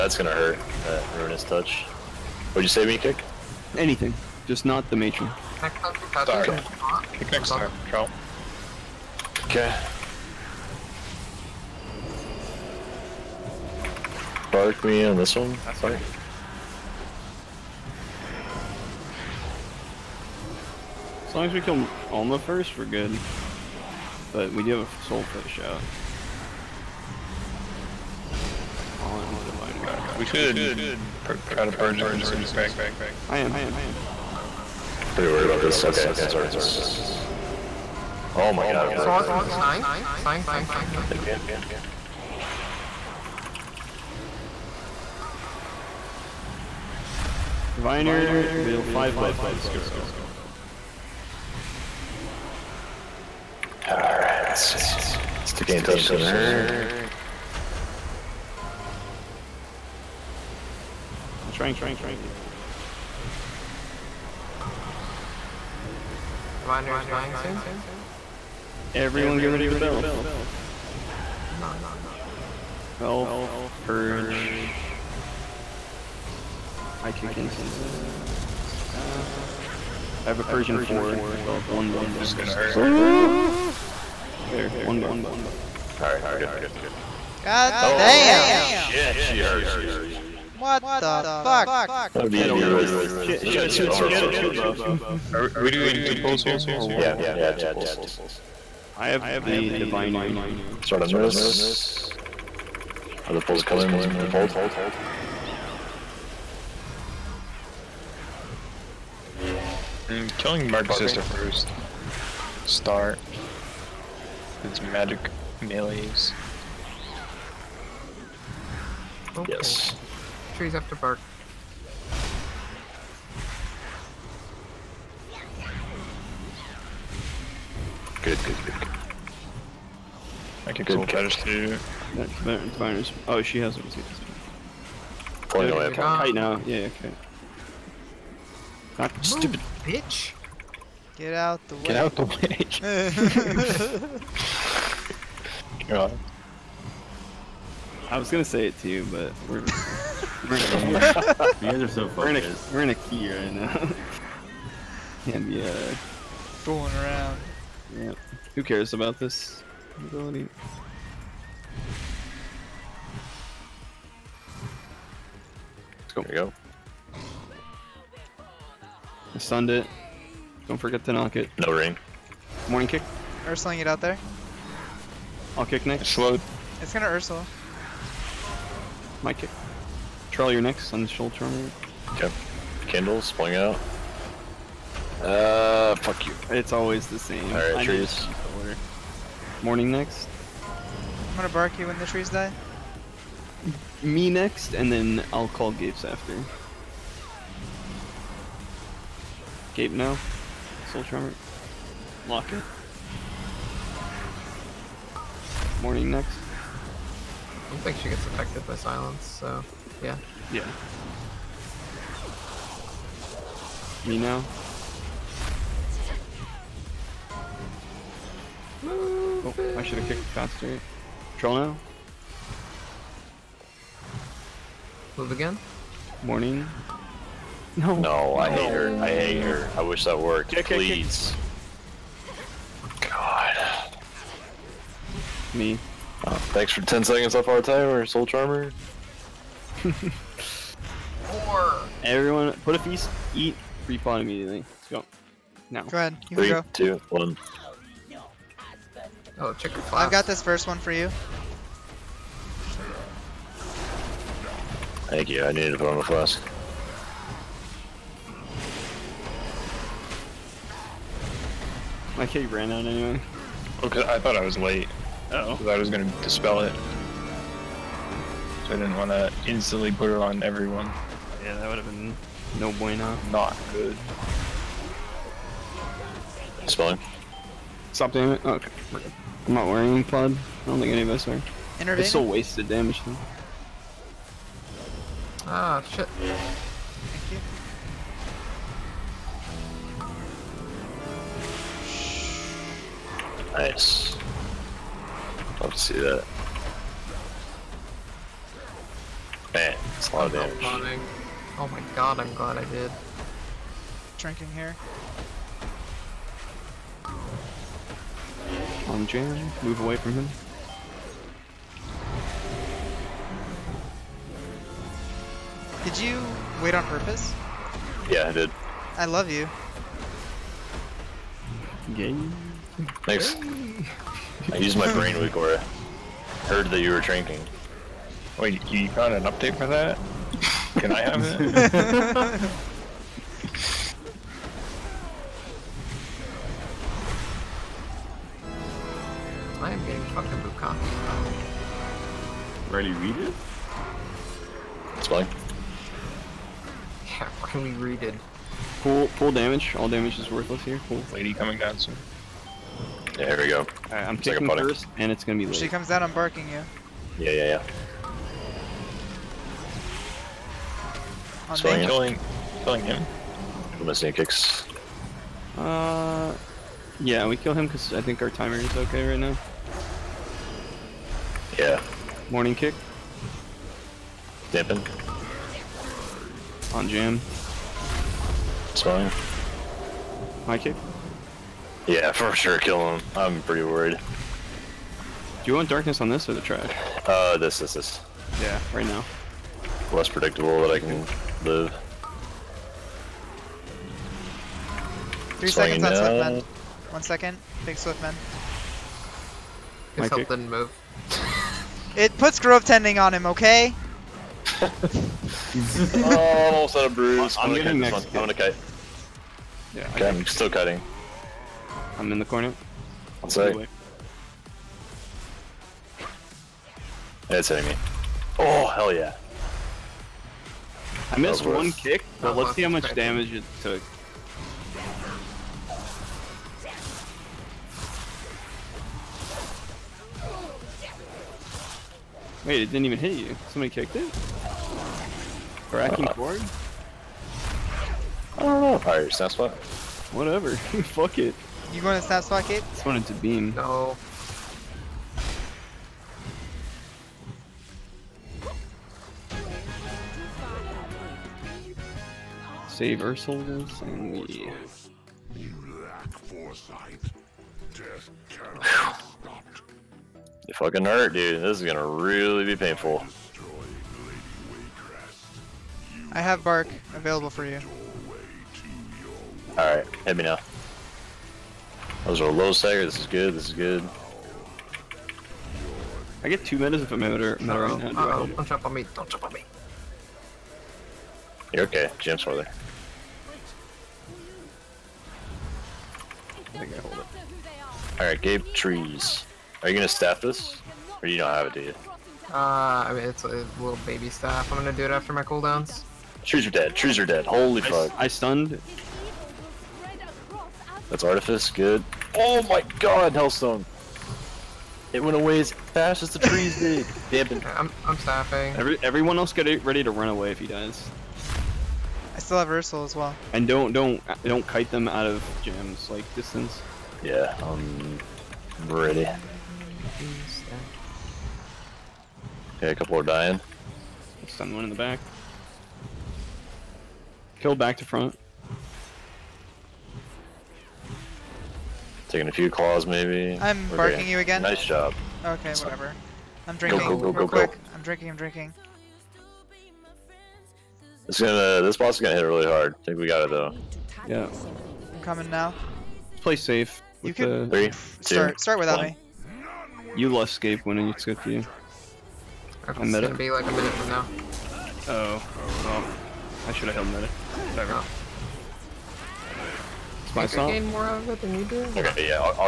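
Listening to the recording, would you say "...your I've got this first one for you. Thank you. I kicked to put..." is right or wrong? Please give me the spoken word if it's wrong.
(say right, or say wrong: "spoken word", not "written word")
wrong: "needed", not "kicked".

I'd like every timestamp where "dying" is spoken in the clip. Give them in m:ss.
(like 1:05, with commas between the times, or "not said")
1:07, 8:43.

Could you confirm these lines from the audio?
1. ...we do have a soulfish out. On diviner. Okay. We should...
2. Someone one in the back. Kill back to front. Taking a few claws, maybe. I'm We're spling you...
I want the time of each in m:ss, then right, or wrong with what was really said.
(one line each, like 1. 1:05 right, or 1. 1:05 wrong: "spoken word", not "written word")
1. 0:24 right
2. 8:44 wrong: "barking", not "spling".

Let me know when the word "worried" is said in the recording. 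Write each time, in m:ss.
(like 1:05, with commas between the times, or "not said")
0:35, 6:23.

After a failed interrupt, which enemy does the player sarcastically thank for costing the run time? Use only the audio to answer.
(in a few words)
Soul Charmer.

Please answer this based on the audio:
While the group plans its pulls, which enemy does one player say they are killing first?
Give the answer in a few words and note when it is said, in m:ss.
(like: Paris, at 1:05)
Marked Sister, at 1:50.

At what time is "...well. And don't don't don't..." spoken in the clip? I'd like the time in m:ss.
8:32.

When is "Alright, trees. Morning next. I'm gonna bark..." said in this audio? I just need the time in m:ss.
3:07.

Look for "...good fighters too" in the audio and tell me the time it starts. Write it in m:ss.
2:10.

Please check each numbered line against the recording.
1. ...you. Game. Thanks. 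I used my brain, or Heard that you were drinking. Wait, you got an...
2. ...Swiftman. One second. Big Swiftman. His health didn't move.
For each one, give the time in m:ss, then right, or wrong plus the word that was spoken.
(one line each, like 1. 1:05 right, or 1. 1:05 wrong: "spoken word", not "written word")
1. 5:19 right
2. 6:35 right.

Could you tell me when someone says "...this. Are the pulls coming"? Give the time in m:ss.
1:41.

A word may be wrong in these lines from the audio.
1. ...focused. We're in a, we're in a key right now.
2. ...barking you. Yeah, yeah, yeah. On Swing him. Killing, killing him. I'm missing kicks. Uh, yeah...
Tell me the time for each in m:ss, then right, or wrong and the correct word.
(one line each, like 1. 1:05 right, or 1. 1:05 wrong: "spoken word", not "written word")
1. 2:32 right
2. 5:56 right.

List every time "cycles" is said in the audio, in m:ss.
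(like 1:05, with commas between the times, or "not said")
not said.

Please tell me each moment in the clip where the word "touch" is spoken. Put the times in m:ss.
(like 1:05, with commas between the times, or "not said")
0:01, 0:55.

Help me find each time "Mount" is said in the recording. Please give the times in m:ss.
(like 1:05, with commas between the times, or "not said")
not said.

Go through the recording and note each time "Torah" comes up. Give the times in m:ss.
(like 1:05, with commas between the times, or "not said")
not said.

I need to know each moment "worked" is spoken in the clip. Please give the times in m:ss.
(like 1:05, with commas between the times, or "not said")
3:50.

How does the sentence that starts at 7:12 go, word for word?
Wait, it didn't even hit you.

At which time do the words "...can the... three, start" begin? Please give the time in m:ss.
9:07.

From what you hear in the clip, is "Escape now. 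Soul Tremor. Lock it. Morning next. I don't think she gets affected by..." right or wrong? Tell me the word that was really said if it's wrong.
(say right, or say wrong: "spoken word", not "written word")
right.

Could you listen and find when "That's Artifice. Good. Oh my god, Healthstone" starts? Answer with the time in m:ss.
8:20.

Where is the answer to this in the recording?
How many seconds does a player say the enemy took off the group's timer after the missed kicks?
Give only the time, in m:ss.
3:56.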